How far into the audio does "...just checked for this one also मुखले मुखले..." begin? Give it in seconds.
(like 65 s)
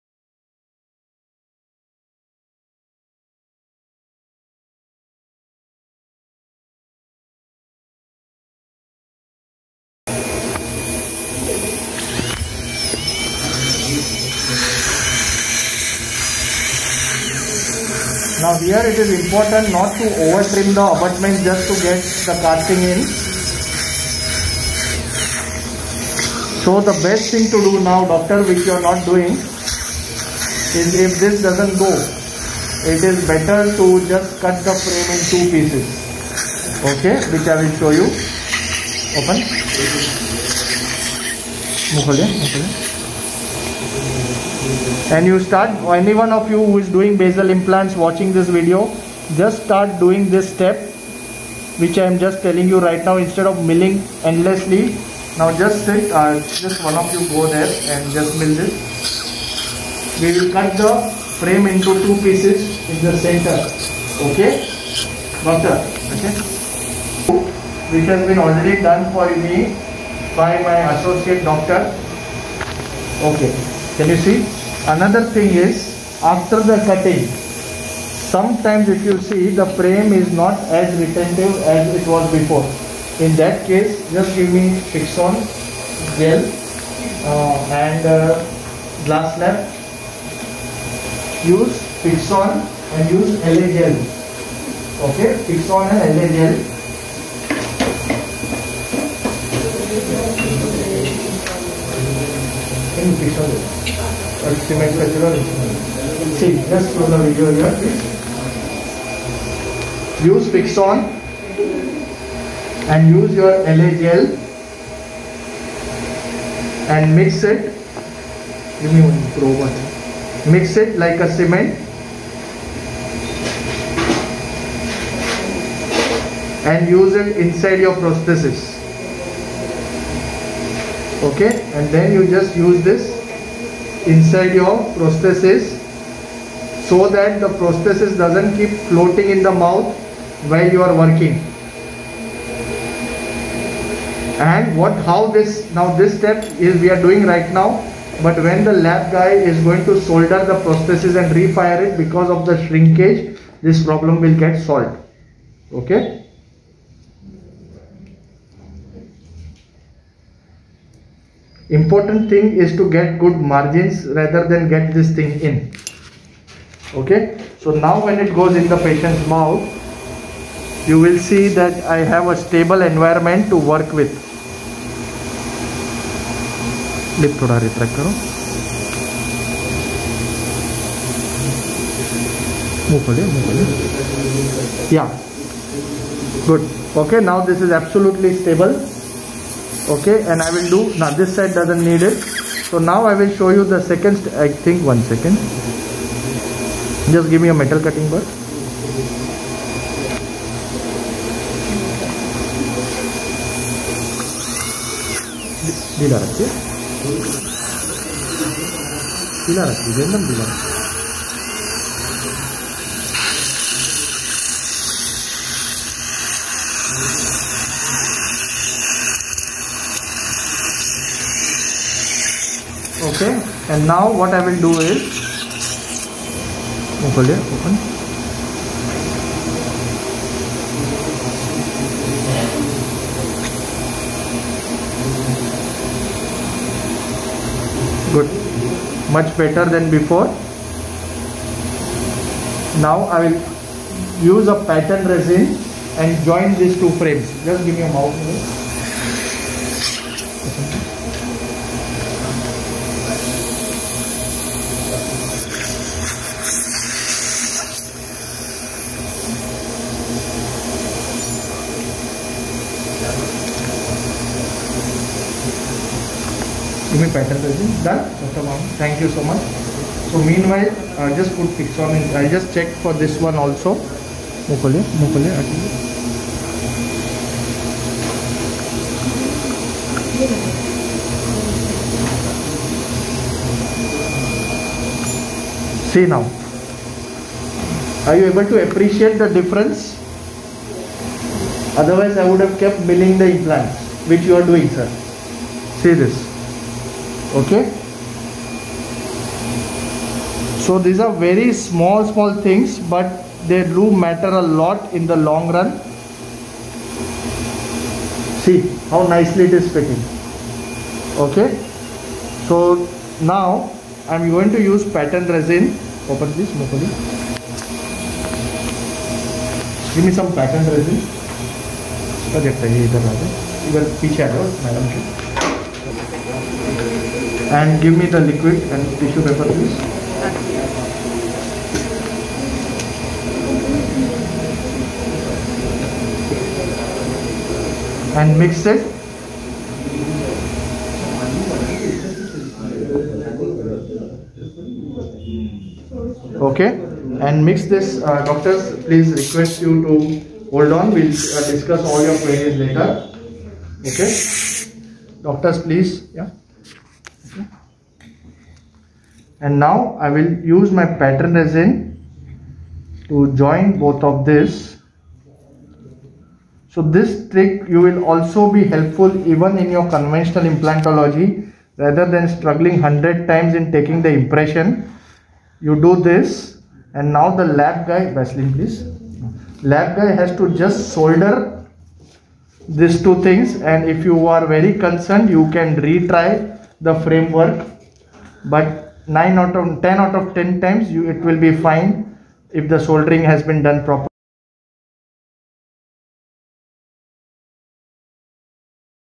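272 s.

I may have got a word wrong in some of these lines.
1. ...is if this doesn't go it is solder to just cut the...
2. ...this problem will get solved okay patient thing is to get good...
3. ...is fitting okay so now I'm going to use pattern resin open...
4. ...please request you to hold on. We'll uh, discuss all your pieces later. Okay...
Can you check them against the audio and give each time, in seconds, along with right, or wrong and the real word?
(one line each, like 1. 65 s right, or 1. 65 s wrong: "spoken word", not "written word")
1. 30 s wrong: "better", not "solder"
2. 153 s wrong: "important", not "patient"
3. 309 s right
4. 348 s wrong: "queries", not "pieces".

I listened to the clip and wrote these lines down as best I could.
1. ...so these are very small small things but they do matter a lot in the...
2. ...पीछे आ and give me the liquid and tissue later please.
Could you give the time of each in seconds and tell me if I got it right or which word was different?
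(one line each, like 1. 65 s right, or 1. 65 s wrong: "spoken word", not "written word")
1. 300 s right
2. 324 s wrong: "paper", not "later".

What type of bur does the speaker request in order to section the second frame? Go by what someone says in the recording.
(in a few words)
Metal cutting bar.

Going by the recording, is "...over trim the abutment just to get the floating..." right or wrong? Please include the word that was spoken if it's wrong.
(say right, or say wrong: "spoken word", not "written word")
wrong: "casting", not "floating".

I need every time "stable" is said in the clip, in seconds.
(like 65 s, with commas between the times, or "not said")
172 s, 188 s.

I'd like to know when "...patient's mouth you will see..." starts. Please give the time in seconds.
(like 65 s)
168 s.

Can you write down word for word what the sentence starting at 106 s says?
See, just for the video here, please.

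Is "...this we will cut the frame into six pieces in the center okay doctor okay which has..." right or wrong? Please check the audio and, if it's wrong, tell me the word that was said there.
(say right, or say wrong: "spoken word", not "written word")
wrong: "two", not "six".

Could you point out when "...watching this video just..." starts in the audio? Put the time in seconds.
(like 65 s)
47 s.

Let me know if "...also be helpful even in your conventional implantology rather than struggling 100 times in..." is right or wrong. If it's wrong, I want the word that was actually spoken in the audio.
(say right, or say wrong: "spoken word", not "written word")
right.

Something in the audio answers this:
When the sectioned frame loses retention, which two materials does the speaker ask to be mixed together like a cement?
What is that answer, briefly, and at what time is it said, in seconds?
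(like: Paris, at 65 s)
Fixon and LA gel, at 95 s.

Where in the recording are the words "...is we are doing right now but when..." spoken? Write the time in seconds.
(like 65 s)
146 s.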